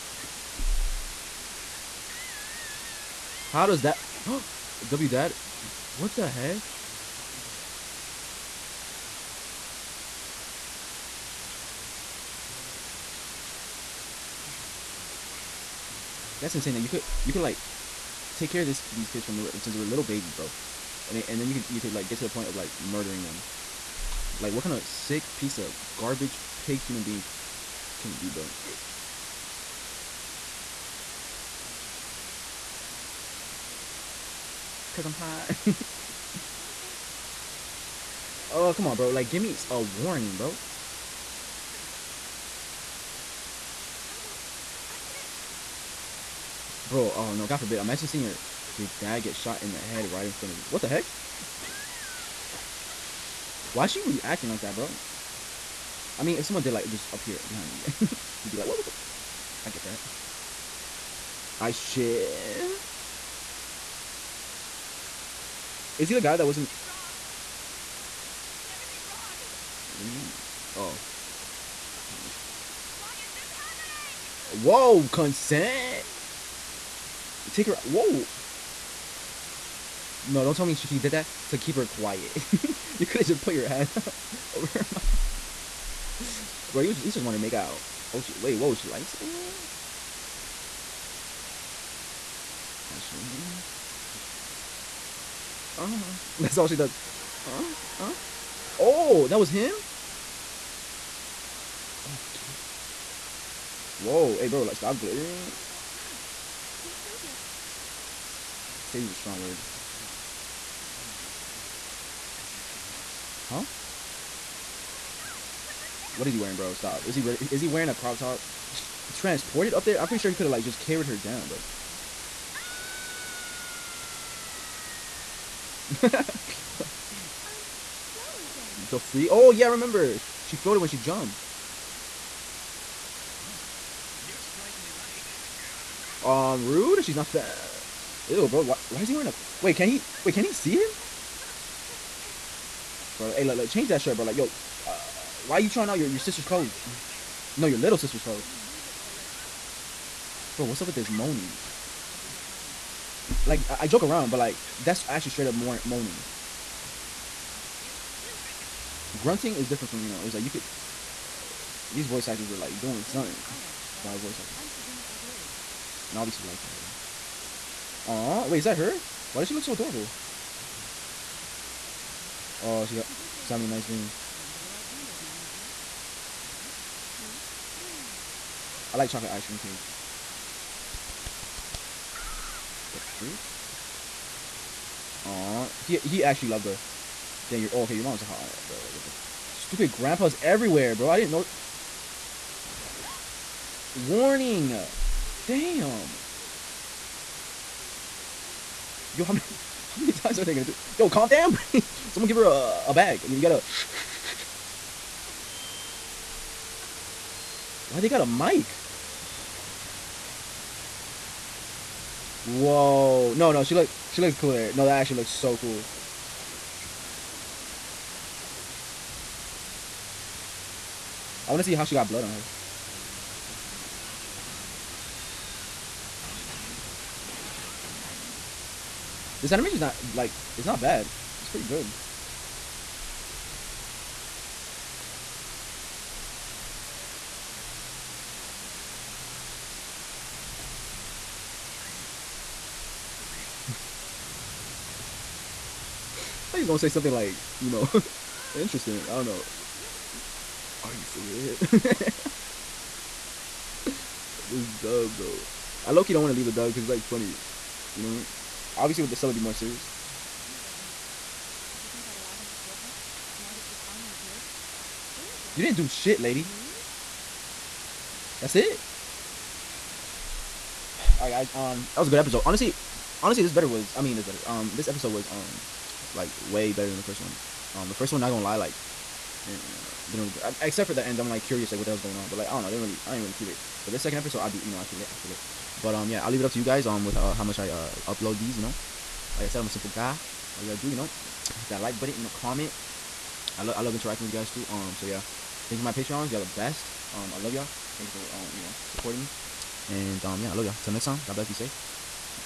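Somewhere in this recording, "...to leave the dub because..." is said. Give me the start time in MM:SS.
04:16.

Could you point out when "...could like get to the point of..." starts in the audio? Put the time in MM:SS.
00:21.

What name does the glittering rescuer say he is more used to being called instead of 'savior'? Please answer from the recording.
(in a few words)
Toya.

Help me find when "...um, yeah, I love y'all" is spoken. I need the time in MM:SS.
05:00.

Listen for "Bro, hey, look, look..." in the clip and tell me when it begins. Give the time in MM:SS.
02:23.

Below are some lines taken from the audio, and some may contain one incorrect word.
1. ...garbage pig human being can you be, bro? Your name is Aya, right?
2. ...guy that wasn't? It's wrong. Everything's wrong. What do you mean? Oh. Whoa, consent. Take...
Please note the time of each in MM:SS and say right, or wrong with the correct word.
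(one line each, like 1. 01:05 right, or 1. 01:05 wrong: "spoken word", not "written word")
1. 00:25 right
2. 01:06 right.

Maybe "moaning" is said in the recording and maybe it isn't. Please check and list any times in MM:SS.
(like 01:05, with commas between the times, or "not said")
02:31, 02:35.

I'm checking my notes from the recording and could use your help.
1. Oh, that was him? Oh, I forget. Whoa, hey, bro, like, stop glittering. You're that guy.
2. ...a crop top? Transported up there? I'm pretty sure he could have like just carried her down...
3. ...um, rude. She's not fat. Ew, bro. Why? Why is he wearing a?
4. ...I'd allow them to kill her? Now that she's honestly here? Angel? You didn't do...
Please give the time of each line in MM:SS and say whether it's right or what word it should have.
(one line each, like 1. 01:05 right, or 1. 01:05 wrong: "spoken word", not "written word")
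1. 01:38 right
2. 01:57 right
3. 02:16 right
4. 04:22 wrong: "finally", not "honestly".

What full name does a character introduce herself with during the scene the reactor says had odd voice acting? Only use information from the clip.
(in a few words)
Suzumi Aogiri.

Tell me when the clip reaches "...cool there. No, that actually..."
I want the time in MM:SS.
03:34.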